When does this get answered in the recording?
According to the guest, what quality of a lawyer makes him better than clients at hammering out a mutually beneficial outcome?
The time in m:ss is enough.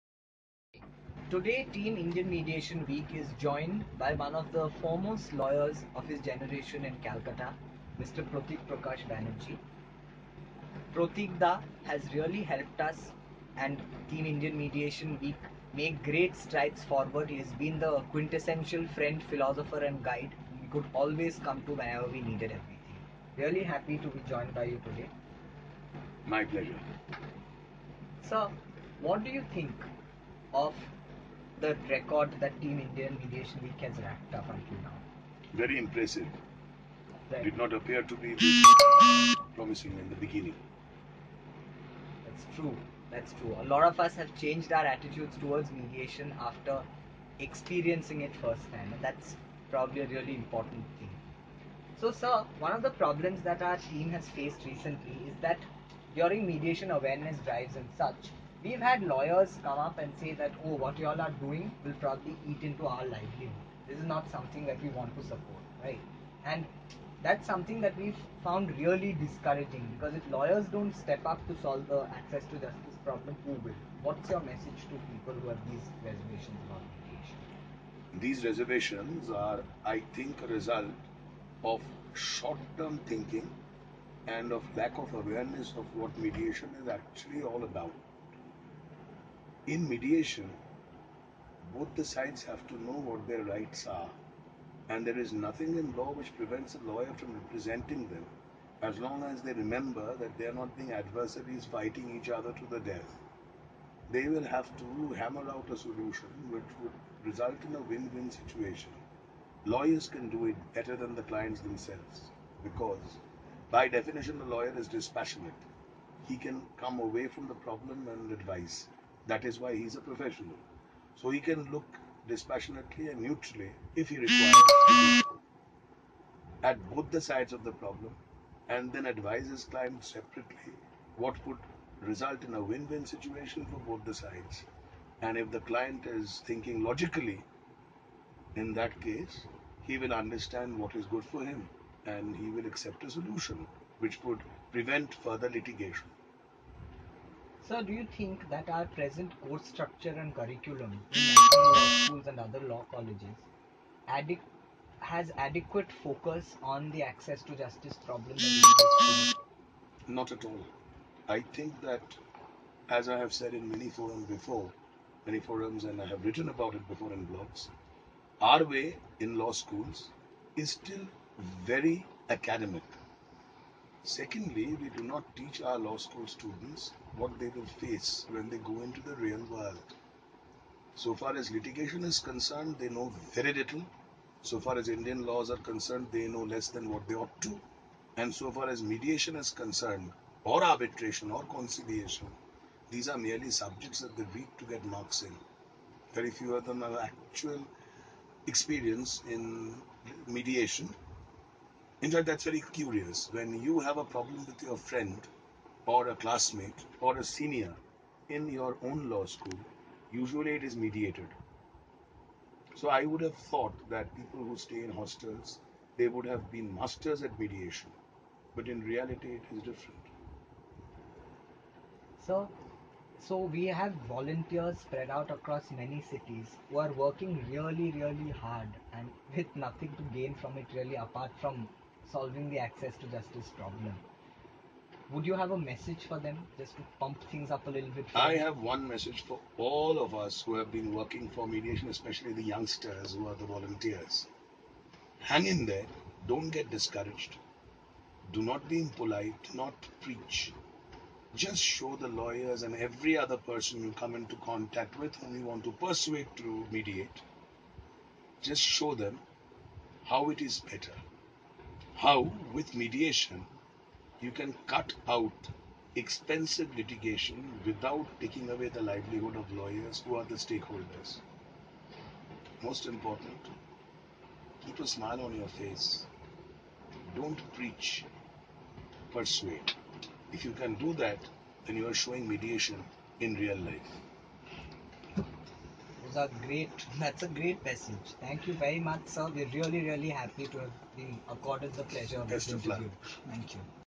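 1:54.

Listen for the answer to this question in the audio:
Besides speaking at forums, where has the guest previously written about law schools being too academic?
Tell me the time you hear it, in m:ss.
2:47.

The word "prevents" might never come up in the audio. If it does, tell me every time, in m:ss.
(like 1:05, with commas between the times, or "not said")
1:36, 2:24.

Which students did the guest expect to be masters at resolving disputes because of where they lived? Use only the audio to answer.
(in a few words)
People who stay in hostels.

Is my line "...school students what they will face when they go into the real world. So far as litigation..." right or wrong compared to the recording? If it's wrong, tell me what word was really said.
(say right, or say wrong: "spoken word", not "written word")
right.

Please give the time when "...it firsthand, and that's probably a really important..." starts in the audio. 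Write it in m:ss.
0:48.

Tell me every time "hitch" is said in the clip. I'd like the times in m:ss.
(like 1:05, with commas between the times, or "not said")
not said.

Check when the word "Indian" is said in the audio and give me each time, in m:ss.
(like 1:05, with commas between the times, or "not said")
0:01, 0:14, 0:32, 3:04.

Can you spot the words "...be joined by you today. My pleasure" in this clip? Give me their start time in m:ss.
0:24.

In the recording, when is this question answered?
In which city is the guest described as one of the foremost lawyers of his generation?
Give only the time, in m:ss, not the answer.
0:07.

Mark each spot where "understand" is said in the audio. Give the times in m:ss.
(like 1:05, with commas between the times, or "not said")
2:20.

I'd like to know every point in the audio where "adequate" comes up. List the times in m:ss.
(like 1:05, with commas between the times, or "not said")
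2:35.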